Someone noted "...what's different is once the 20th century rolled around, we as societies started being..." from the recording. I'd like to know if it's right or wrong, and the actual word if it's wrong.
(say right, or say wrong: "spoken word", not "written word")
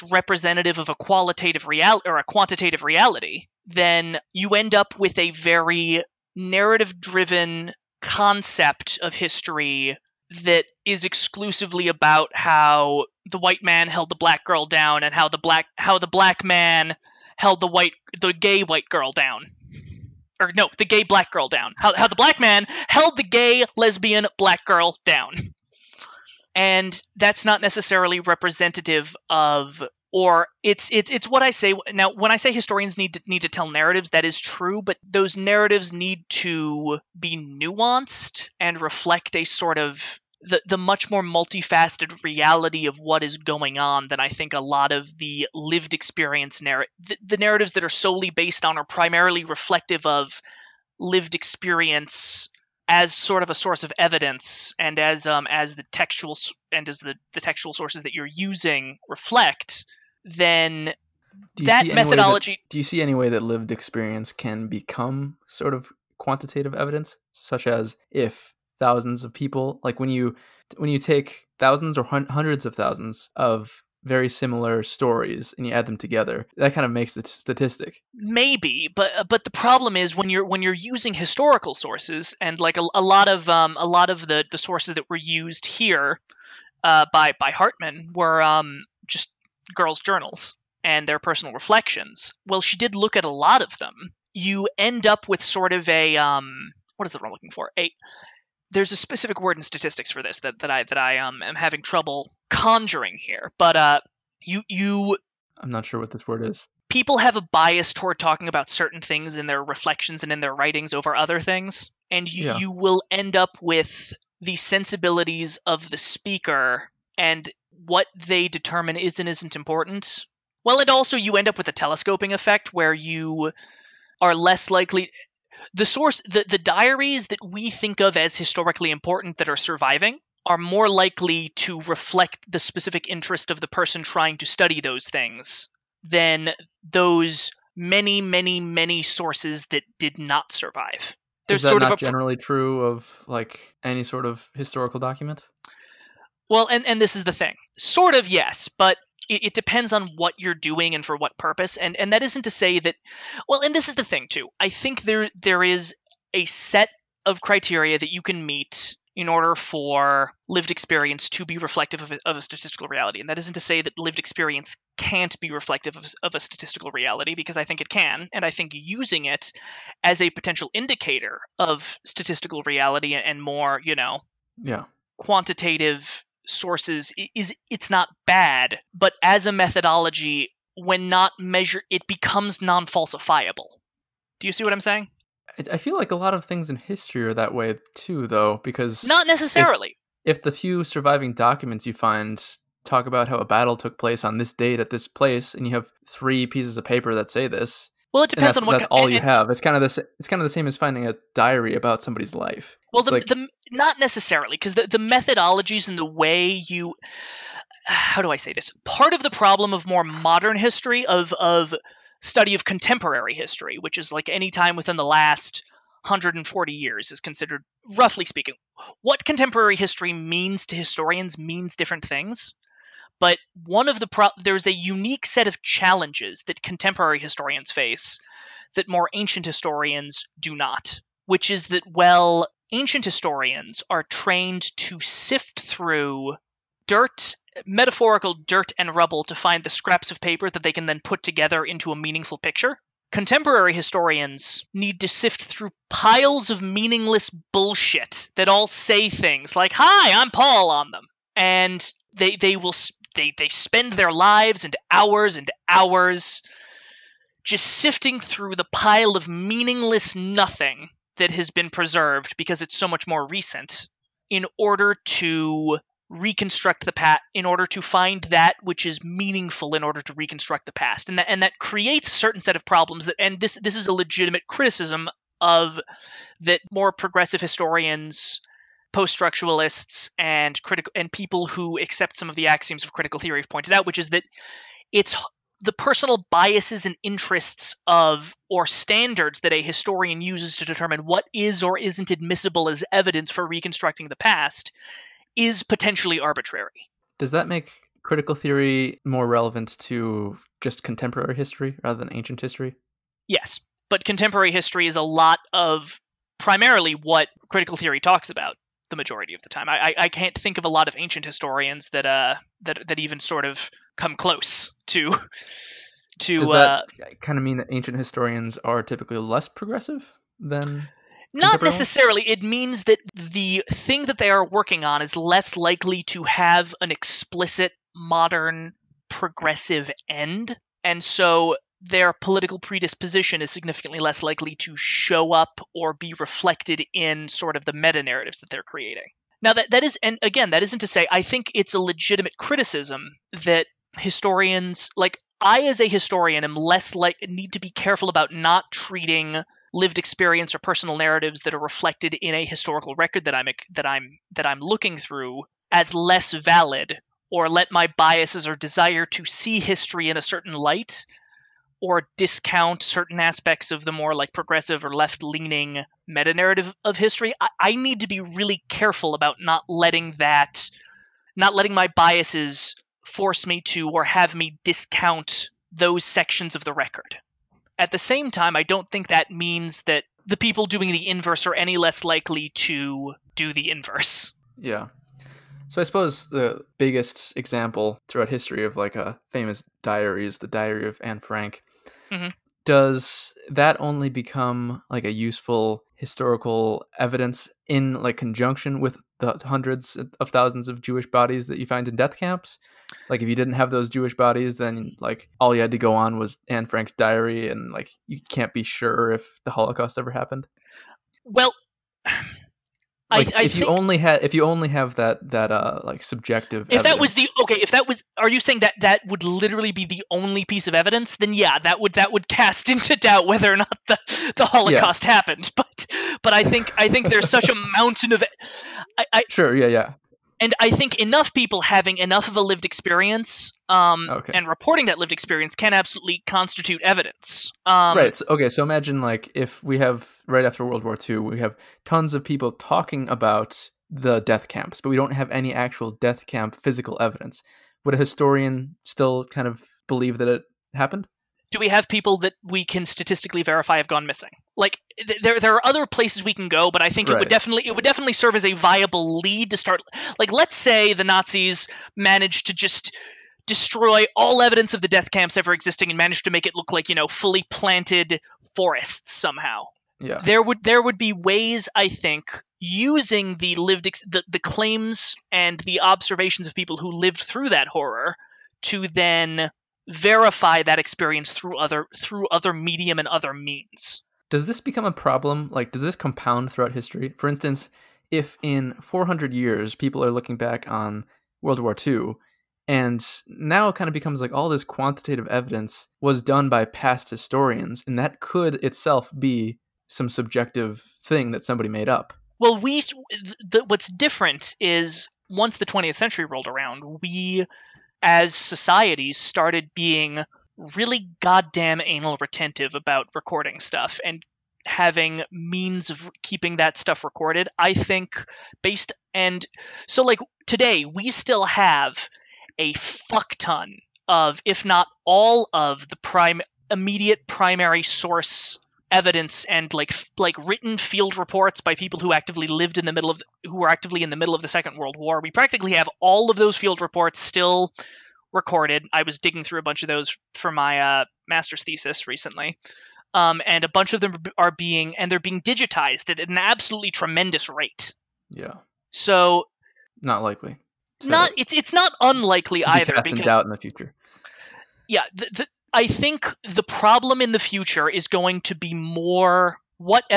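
right.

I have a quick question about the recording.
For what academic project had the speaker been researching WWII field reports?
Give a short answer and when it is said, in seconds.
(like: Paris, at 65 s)
master's thesis, at 541 s.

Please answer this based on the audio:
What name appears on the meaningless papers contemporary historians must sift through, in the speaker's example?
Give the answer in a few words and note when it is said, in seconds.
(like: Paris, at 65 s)
Paul, at 249 s.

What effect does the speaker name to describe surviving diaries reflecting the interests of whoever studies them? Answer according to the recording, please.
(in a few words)
telescoping effect.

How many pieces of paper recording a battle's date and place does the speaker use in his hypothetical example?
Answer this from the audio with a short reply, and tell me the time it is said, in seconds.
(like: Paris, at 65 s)
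3, at 196 s.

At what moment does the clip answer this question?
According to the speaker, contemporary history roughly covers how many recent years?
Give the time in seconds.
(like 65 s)
216 s.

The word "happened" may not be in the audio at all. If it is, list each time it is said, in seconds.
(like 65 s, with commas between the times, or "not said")
410 s, 425 s, 450 s.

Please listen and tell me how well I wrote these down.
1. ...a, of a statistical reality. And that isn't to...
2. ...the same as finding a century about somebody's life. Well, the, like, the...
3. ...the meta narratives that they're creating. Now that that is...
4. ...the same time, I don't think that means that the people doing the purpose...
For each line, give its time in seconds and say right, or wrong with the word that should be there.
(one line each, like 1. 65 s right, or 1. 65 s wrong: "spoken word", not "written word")
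1. 162 s right
2. 200 s wrong: "diary", not "century"
3. 337 s right
4. 377 s wrong: "inverse", not "purpose".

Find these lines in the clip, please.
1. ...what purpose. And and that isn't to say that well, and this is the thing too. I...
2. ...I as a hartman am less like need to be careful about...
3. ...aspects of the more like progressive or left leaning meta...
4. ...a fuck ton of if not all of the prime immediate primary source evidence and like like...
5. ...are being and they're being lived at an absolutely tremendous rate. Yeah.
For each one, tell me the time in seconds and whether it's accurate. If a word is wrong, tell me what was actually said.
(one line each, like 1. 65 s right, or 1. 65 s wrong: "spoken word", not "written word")
1. 151 s right
2. 345 s wrong: "historian", not "hartman"
3. 363 s right
4. 522 s right
5. 544 s wrong: "digitized", not "lived".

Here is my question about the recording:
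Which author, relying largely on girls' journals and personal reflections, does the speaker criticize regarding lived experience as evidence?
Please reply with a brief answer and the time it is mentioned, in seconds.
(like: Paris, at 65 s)
Hartman, at 87 s.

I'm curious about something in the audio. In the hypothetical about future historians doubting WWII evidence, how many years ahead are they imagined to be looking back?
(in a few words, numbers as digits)
400.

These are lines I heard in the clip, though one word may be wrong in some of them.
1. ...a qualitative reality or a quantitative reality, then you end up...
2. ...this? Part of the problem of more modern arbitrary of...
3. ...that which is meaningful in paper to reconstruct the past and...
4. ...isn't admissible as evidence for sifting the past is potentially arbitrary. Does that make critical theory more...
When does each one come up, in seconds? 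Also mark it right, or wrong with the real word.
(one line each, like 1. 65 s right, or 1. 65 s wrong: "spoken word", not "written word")
1. 0 s right
2. 208 s wrong: "history", not "arbitrary"
3. 268 s wrong: "order", not "paper"
4. 291 s wrong: "reconstructing", not "sifting".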